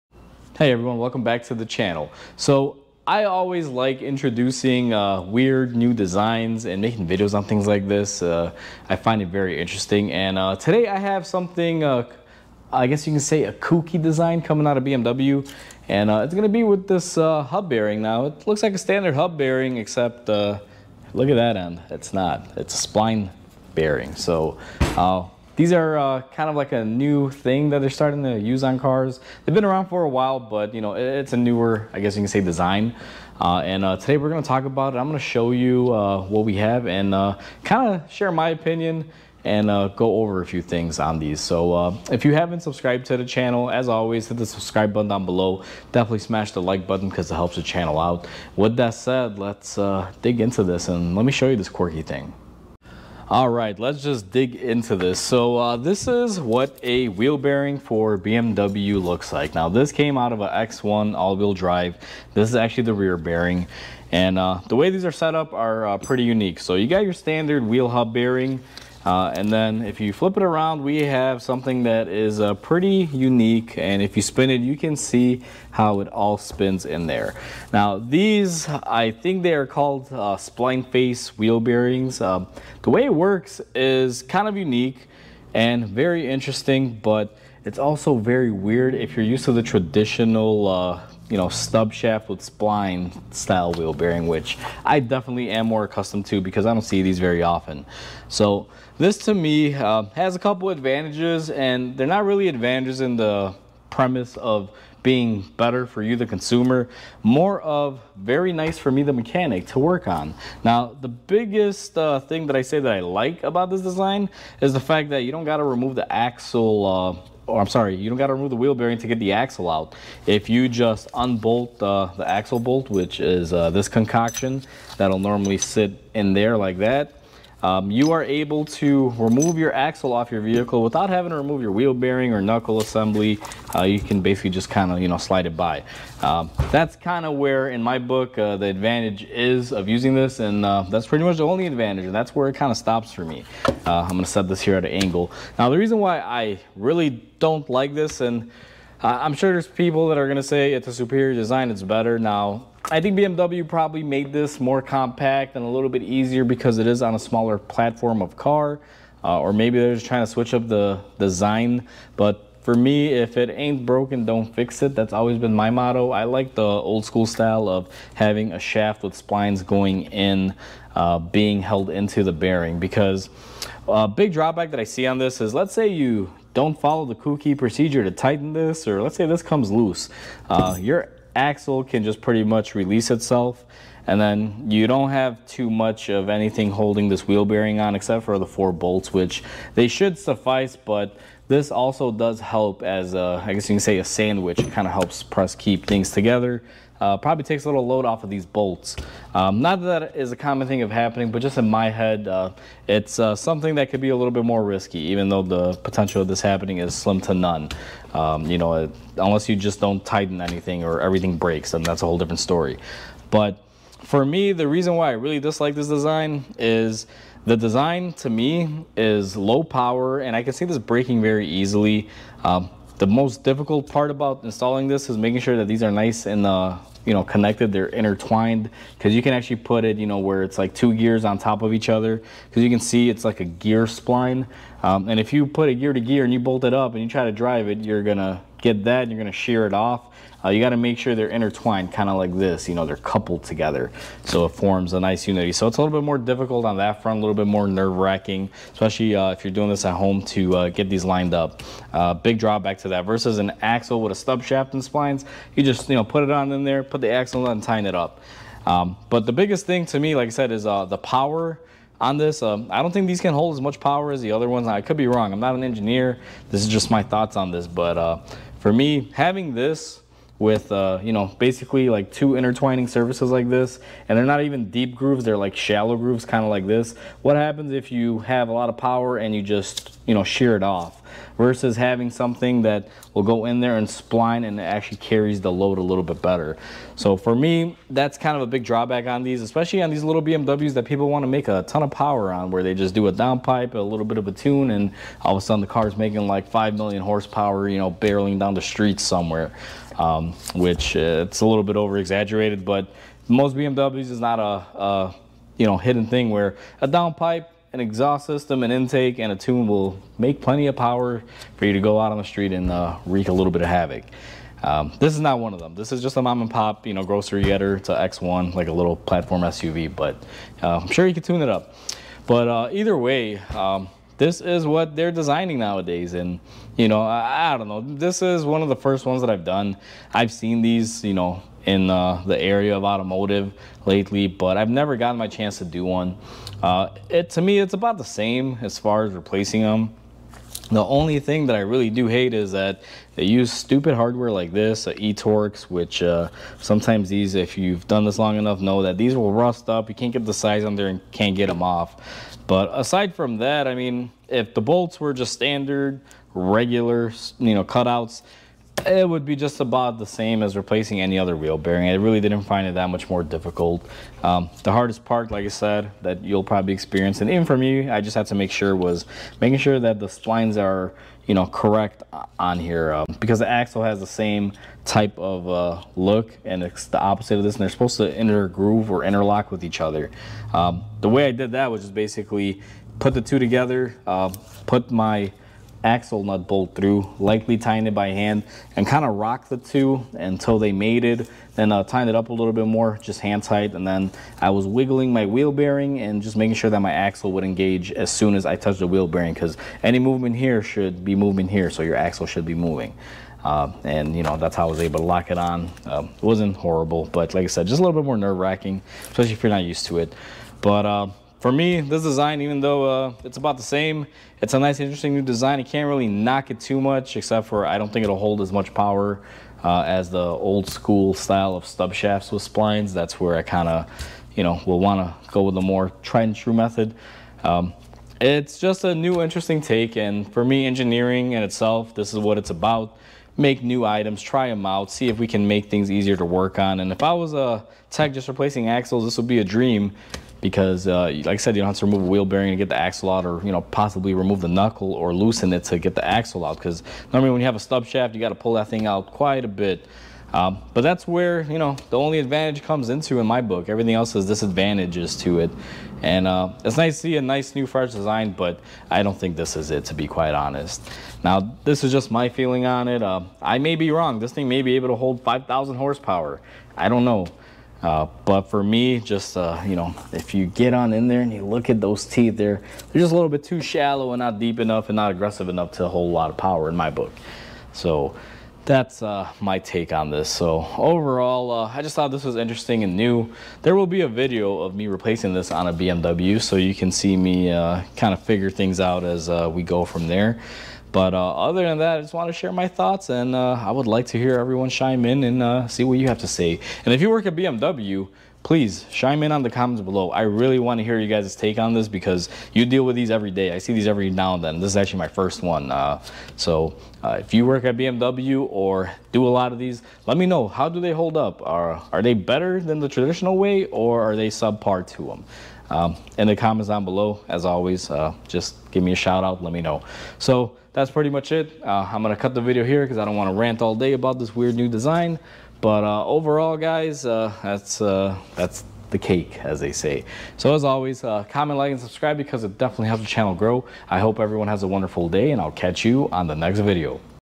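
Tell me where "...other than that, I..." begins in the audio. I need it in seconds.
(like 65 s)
491 s.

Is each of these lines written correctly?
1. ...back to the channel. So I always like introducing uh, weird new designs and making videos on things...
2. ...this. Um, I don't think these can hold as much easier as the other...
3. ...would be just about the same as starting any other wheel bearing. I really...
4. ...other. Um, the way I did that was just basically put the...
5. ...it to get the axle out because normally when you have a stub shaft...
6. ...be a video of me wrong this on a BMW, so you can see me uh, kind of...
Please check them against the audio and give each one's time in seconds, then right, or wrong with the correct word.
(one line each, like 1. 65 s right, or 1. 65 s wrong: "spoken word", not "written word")
1. 1 s right
2. 262 s wrong: "power", not "easier"
3. 359 s wrong: "replacing", not "starting"
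4. 379 s right
5. 445 s right
6. 483 s wrong: "replacing", not "wrong".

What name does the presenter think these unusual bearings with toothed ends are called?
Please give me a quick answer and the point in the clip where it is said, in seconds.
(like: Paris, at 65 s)
Spline face wheel bearings, at 80 s.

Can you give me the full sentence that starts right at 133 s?
Uh, you can basically just kind of, you know, slide it by.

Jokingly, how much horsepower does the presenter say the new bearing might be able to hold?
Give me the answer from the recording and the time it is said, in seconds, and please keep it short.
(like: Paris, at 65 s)
5,000 horsepower, at 465 s.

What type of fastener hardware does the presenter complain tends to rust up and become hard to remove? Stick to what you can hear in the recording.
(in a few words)
E-torx.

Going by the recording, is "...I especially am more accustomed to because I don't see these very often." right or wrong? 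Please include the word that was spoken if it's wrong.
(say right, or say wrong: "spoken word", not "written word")
wrong: "definitely", not "especially".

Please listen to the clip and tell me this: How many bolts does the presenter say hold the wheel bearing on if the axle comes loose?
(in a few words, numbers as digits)
4.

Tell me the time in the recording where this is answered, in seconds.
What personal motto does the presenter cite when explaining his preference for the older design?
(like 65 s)
163 s.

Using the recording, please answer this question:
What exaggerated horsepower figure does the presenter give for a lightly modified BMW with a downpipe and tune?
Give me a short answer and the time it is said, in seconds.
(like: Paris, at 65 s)
5 million horsepower, at 296 s.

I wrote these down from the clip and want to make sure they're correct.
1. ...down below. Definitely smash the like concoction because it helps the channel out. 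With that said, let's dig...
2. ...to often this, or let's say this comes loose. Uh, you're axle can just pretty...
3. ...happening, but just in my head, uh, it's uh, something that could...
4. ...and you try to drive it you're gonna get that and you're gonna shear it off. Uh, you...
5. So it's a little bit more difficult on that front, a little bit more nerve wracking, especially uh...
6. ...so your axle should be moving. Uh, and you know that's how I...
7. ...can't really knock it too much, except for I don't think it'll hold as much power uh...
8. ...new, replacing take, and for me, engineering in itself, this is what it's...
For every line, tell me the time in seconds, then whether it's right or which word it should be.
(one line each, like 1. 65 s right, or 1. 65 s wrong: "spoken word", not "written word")
1. 45 s wrong: "button", not "concoction"
2. 178 s wrong: "tighten", not "often"
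3. 200 s right
4. 236 s right
5. 245 s right
6. 401 s right
7. 415 s right
8. 428 s wrong: "interesting", not "replacing".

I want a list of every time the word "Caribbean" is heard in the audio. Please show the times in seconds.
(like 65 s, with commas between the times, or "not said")
not said.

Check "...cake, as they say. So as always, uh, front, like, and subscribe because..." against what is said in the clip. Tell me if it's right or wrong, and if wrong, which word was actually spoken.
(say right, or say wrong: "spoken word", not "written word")
wrong: "comment", not "front".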